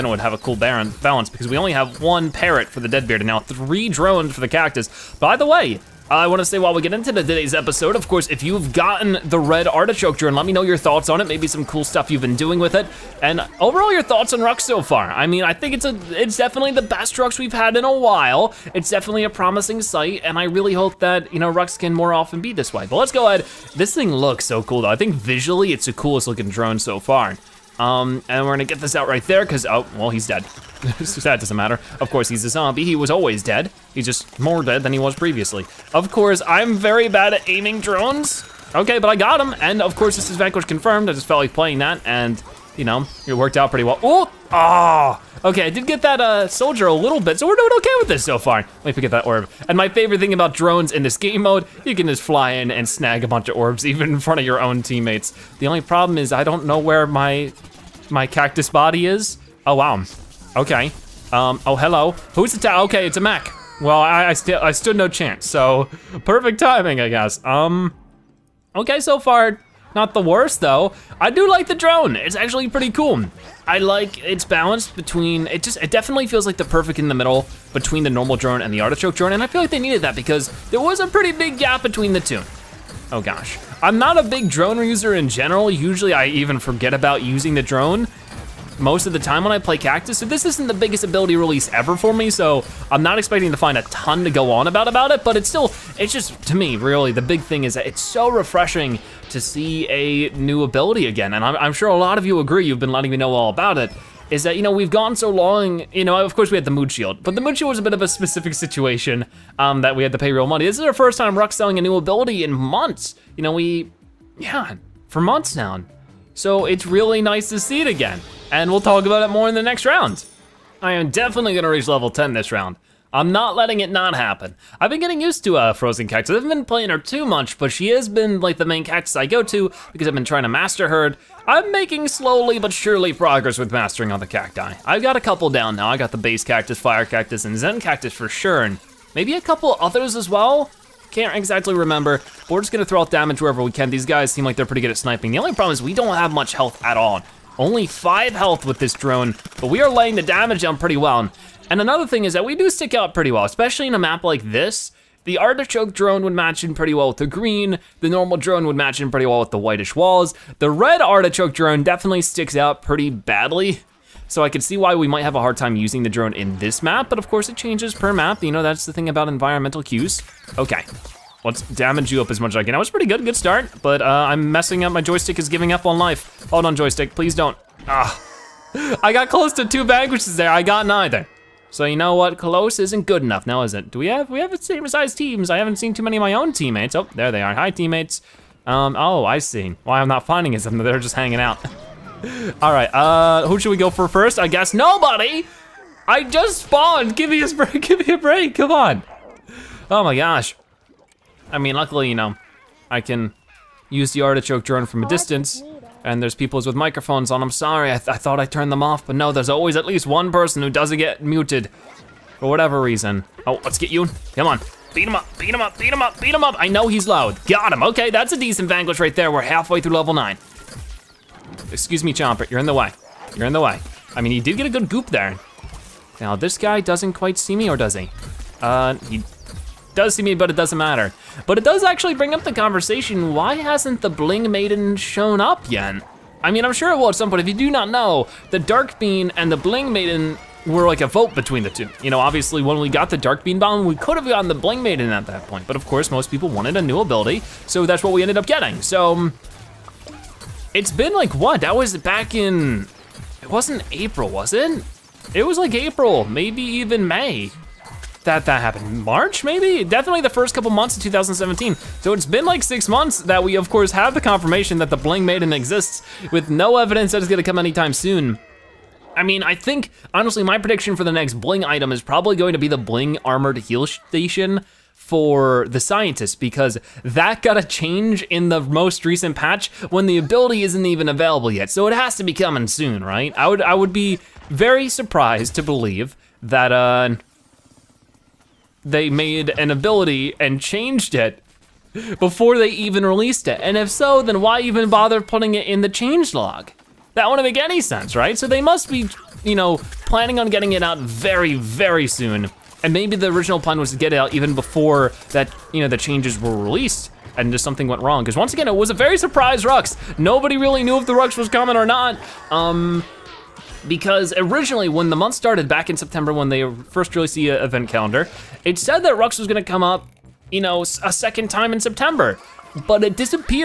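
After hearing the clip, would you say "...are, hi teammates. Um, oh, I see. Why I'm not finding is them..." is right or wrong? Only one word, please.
right.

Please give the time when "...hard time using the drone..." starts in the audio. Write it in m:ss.
2:45.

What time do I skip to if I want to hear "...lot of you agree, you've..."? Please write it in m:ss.
1:41.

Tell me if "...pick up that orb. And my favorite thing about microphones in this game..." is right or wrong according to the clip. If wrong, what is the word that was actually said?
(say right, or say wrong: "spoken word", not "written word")
wrong: "drones", not "microphones".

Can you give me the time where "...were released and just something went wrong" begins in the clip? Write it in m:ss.
5:06.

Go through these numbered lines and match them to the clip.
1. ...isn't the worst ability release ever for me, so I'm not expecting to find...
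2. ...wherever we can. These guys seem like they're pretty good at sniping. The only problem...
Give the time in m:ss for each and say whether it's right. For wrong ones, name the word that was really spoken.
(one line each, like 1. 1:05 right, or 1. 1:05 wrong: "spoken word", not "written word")
1. 1:30 wrong: "biggest", not "worst"
2. 2:23 right.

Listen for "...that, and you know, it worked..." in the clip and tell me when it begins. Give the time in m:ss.
0:41.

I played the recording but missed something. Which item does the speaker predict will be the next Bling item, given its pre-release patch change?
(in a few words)
Bling Armored Heal Station.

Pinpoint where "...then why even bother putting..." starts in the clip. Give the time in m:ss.
4:54.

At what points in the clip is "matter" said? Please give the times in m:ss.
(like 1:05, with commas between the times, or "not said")
0:31, 3:50.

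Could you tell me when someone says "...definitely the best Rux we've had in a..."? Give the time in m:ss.
0:16.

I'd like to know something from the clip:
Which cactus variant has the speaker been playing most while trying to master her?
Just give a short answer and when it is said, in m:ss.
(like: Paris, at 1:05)
Frozen Cactus, at 2:05.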